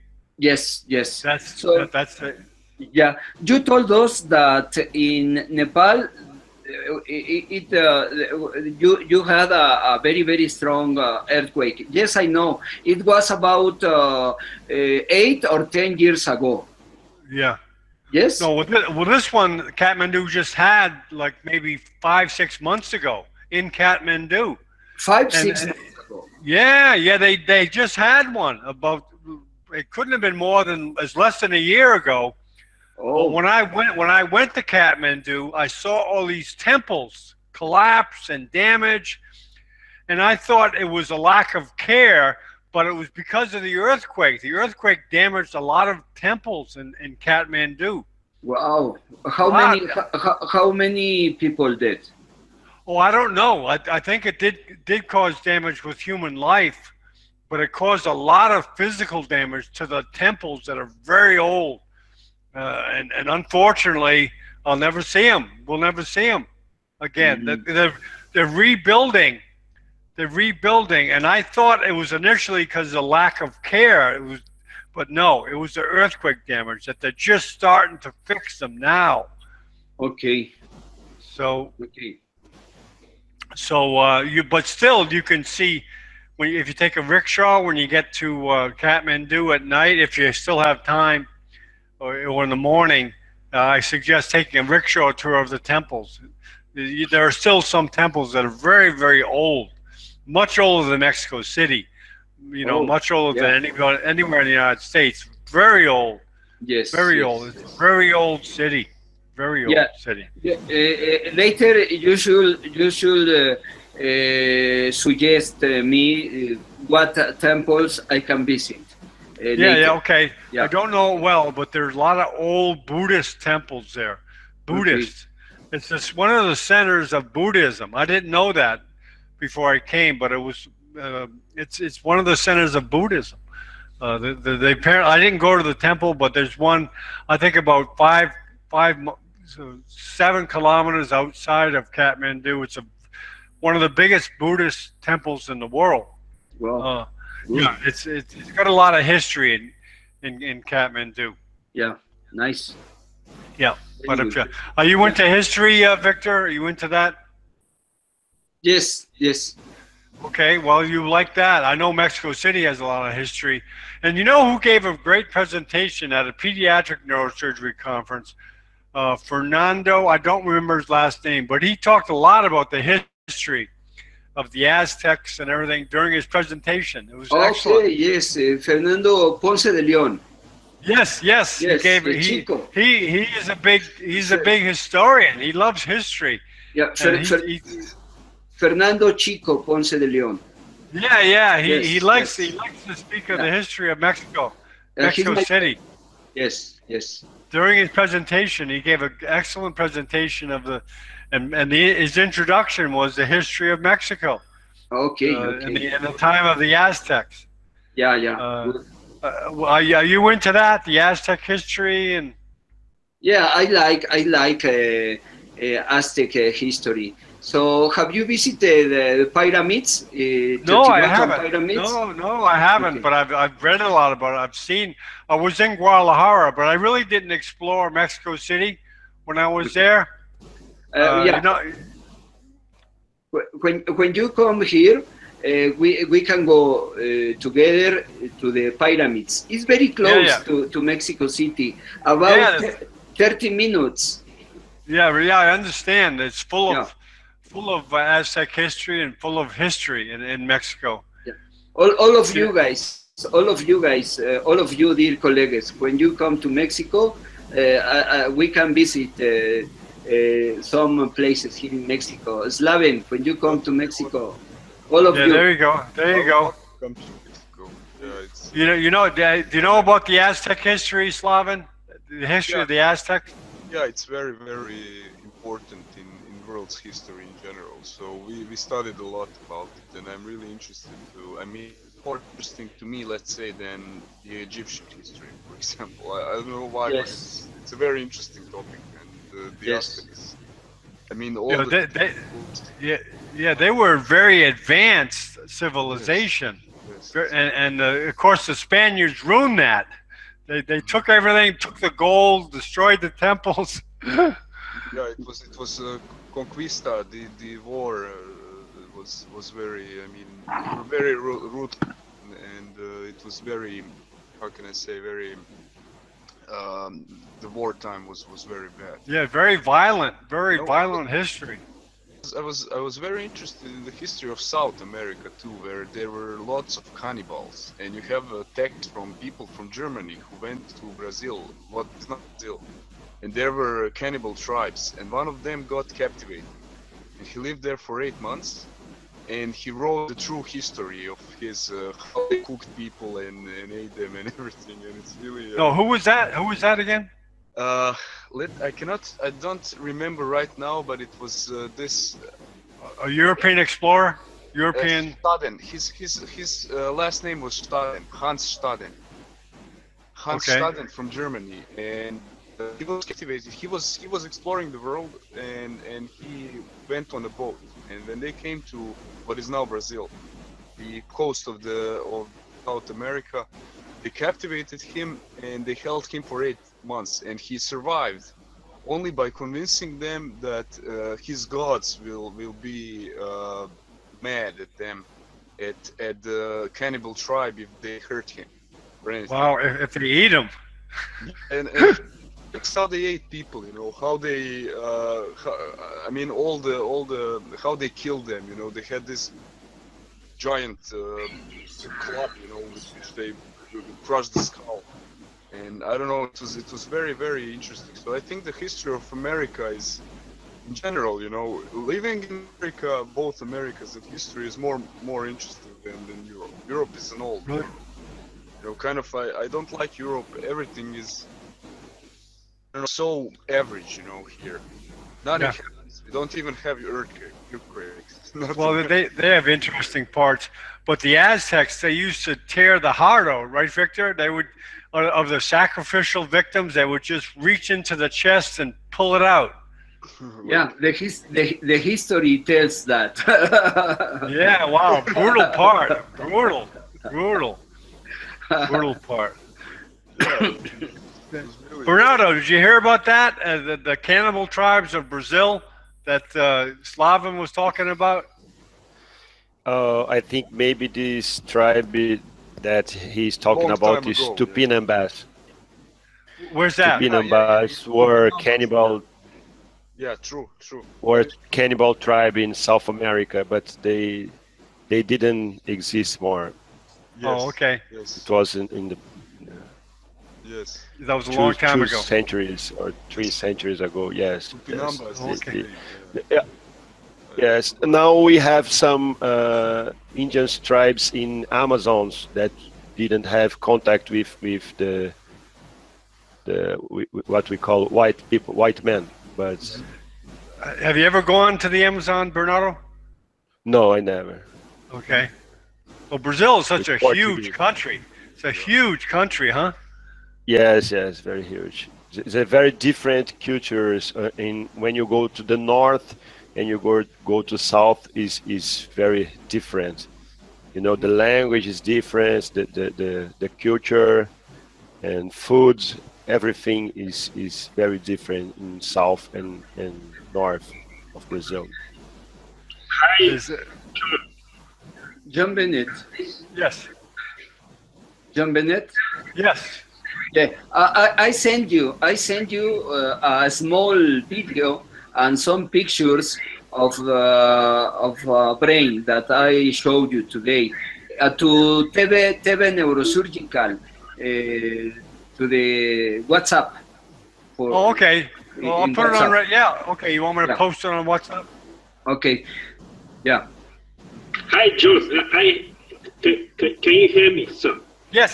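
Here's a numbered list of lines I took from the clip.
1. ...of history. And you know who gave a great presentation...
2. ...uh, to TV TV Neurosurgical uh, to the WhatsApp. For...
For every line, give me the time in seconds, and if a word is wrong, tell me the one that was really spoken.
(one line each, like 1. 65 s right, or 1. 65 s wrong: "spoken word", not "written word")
1. 163 s right
2. 551 s right.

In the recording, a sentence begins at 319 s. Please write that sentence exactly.
Yeah, very violent, very no, violent history.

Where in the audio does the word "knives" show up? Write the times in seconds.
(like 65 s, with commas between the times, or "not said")
not said.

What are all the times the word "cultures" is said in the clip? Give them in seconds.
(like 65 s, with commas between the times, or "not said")
513 s, 523 s.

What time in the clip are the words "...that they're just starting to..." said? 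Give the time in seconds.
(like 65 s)
76 s.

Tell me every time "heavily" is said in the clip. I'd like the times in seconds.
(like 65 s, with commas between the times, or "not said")
not said.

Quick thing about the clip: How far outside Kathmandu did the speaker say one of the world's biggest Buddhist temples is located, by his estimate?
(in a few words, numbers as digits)
7 kilometers.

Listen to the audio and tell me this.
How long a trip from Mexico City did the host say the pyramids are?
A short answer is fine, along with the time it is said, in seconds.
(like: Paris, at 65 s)
30 minutes, at 243 s.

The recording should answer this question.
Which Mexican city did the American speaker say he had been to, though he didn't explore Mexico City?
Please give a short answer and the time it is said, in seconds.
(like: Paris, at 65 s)
Guadalajara, at 225 s.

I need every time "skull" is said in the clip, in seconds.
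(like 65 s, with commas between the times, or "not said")
404 s.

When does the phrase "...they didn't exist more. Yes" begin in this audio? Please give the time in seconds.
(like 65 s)
474 s.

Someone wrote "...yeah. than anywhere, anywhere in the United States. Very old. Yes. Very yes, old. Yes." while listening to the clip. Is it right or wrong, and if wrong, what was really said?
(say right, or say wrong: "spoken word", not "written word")
right.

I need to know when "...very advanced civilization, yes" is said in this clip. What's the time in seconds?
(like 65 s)
293 s.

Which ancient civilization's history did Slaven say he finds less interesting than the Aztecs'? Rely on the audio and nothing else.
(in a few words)
Egyptian.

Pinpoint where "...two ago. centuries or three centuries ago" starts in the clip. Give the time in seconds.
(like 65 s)
481 s.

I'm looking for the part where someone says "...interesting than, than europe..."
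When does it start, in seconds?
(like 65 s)
415 s.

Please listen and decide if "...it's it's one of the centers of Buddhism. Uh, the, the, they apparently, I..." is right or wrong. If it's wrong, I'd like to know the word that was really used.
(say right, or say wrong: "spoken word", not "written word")
right.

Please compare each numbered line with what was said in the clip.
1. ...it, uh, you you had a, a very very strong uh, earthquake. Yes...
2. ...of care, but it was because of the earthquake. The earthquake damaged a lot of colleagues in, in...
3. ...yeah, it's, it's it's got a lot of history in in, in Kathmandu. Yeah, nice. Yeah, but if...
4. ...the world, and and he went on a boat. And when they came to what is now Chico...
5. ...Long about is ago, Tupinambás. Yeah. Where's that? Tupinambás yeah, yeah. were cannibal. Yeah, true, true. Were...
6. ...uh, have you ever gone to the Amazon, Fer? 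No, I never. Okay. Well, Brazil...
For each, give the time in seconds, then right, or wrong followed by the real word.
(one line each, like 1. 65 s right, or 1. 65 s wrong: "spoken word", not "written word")
1. 7 s right
2. 41 s wrong: "temples", not "colleagues"
3. 147 s right
4. 364 s wrong: "Brazil", not "Chico"
5. 463 s right
6. 500 s wrong: "Bernardo", not "Fer".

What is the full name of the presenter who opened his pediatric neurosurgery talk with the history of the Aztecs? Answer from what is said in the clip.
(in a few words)
Fernando Chico Ponce de Leon.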